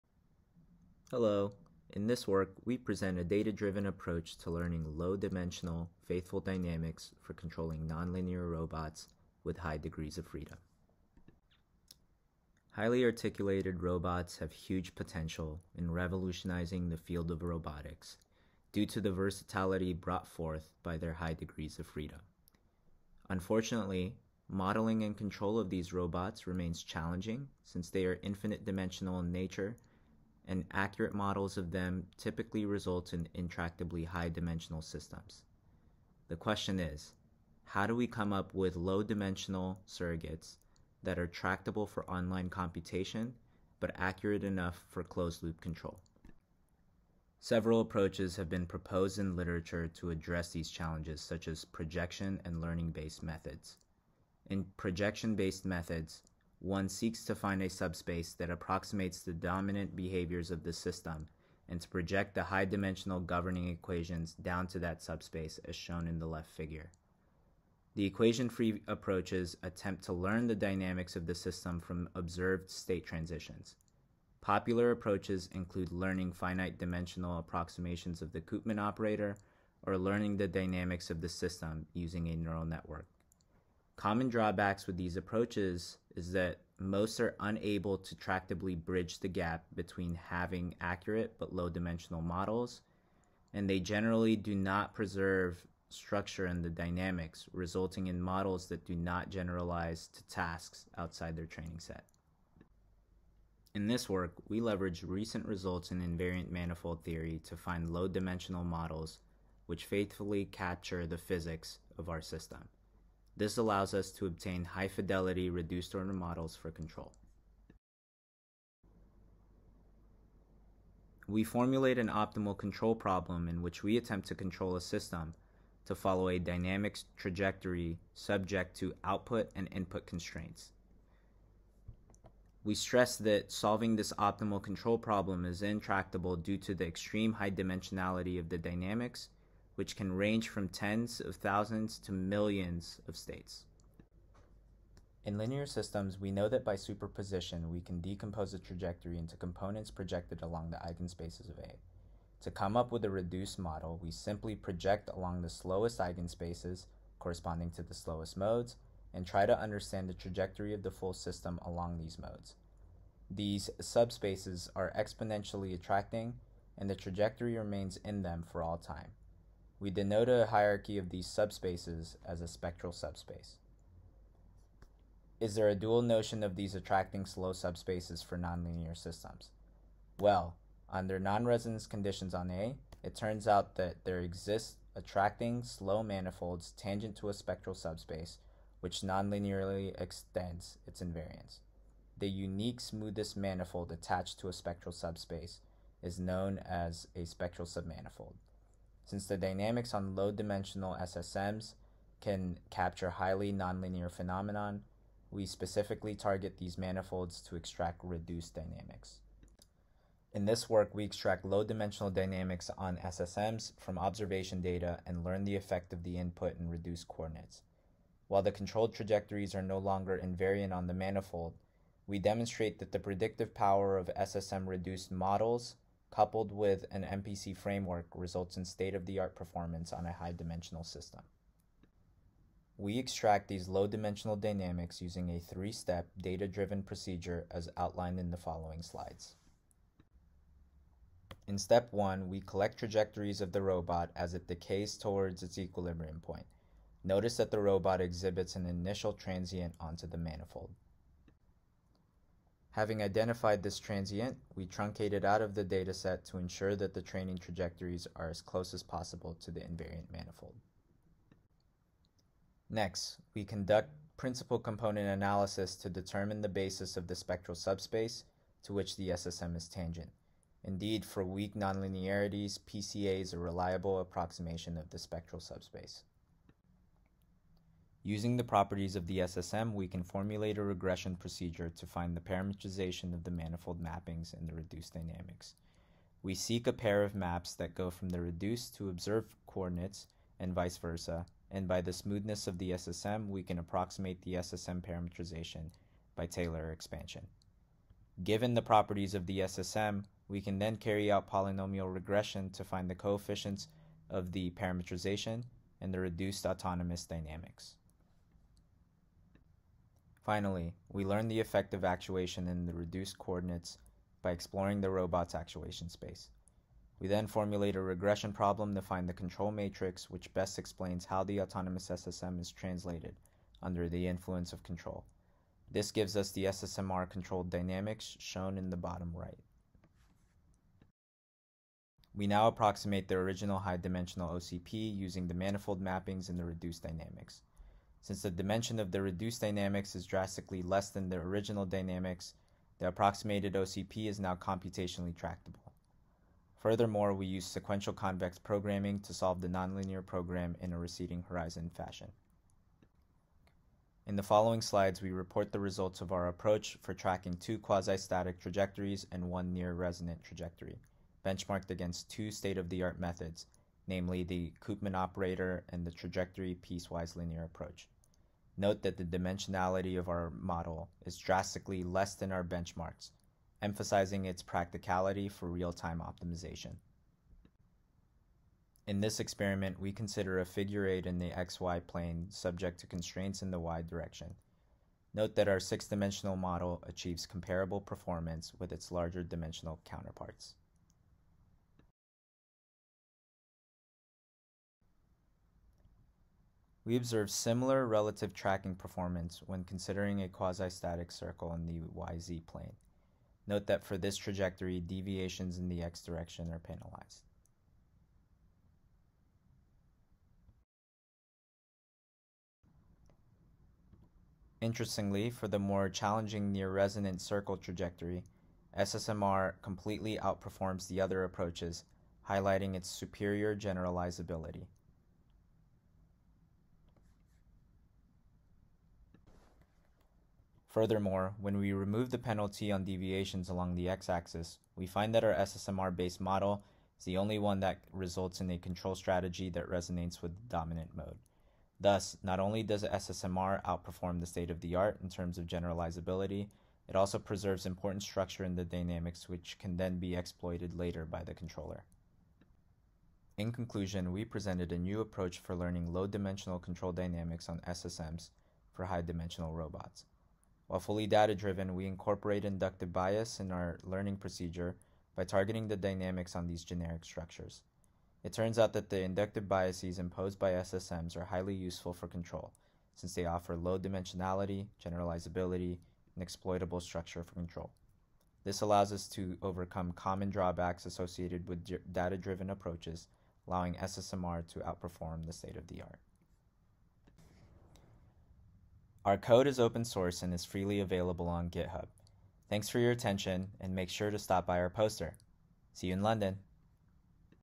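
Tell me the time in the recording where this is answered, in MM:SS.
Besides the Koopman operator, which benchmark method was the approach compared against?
06:05.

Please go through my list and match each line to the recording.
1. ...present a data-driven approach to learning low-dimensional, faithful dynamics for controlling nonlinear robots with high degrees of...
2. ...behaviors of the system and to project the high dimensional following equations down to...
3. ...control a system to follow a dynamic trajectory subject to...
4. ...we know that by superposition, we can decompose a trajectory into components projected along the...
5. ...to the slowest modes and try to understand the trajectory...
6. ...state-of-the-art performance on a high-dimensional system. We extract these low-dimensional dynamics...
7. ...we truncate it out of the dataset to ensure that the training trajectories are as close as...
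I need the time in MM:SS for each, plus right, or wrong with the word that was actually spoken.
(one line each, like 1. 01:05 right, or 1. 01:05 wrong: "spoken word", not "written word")
1. 00:02 right
2. 00:59 wrong: "governing", not "following"
3. 02:04 right
4. 02:26 right
5. 02:37 right
6. 03:48 right
7. 04:14 right.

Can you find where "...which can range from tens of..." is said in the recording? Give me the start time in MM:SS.
02:19.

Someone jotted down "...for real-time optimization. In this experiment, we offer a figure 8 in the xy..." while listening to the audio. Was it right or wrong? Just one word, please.
wrong.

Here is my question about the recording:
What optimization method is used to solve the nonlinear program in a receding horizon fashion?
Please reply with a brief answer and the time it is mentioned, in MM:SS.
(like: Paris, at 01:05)
sequential convex programming, at 05:47.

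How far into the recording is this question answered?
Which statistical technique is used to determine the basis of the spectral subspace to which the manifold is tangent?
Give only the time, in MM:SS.
04:24.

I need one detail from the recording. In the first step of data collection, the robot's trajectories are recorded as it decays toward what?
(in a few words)
its equilibrium point.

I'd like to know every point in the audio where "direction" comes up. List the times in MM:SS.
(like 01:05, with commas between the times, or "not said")
06:23, 06:46.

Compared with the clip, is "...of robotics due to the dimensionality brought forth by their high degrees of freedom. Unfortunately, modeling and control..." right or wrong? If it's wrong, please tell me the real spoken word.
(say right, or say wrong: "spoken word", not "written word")
wrong: "versatility", not "dimensionality".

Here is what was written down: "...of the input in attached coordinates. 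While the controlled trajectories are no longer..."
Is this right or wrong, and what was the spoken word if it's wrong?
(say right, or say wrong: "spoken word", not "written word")
wrong: "reduced", not "attached".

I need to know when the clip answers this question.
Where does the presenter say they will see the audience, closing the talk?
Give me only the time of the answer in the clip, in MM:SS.
08:16.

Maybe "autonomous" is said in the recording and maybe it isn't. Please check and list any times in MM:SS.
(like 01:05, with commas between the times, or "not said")
05:06, 05:21.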